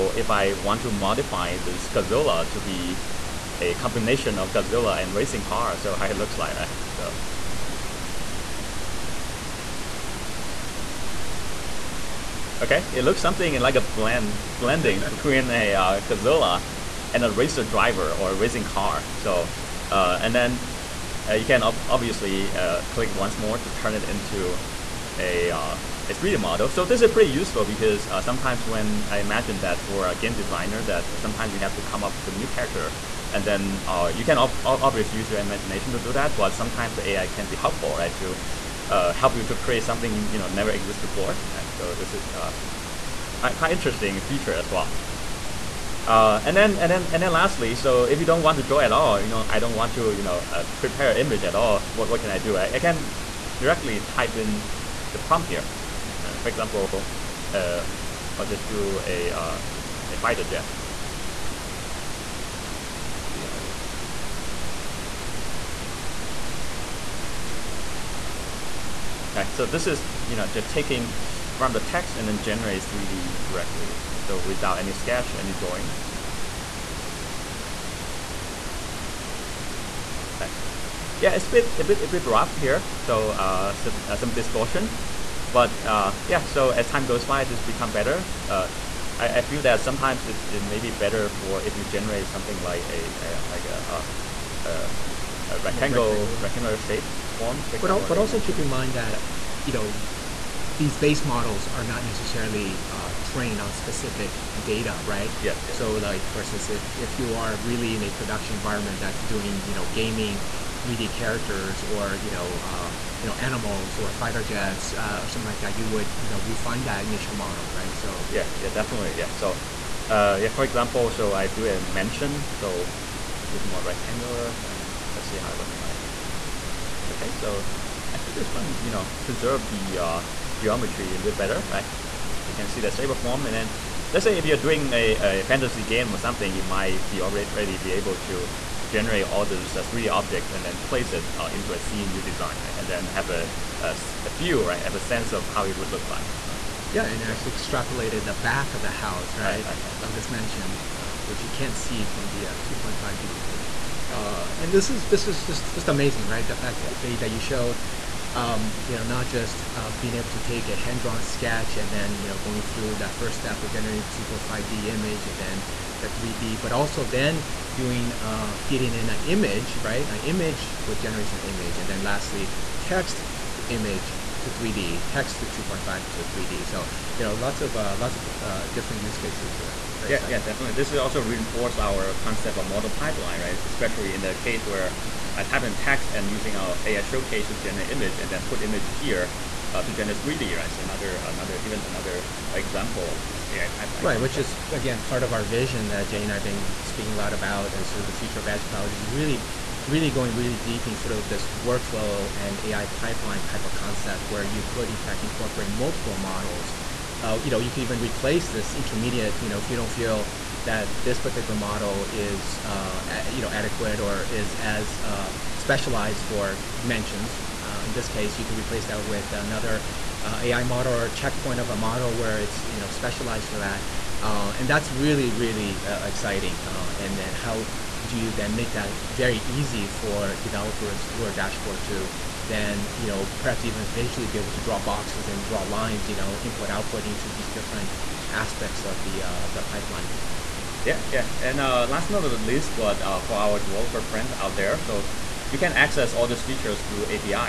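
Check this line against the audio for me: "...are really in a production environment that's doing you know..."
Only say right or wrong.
right.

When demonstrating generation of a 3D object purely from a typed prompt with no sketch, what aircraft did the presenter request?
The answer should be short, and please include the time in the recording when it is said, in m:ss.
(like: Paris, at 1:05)
Fighter jet, at 1:00.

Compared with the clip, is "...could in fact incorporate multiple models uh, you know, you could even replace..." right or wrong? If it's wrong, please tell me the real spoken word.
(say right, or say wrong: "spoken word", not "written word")
right.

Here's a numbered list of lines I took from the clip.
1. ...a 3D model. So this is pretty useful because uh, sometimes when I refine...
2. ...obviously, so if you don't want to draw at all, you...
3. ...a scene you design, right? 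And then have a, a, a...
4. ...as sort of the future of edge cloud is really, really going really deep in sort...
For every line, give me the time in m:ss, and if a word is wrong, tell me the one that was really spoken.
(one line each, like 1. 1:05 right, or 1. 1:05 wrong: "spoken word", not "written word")
1. 0:26 wrong: "imagine", not "refine"
2. 0:47 wrong: "lastly", not "obviously"
3. 2:21 right
4. 3:17 right.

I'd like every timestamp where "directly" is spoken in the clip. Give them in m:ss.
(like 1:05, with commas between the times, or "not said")
0:53, 1:13.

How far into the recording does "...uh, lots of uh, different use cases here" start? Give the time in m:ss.
2:57.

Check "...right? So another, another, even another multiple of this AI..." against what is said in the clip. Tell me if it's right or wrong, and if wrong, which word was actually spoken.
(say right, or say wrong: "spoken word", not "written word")
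wrong: "example", not "multiple".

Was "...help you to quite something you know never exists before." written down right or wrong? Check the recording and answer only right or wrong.
wrong.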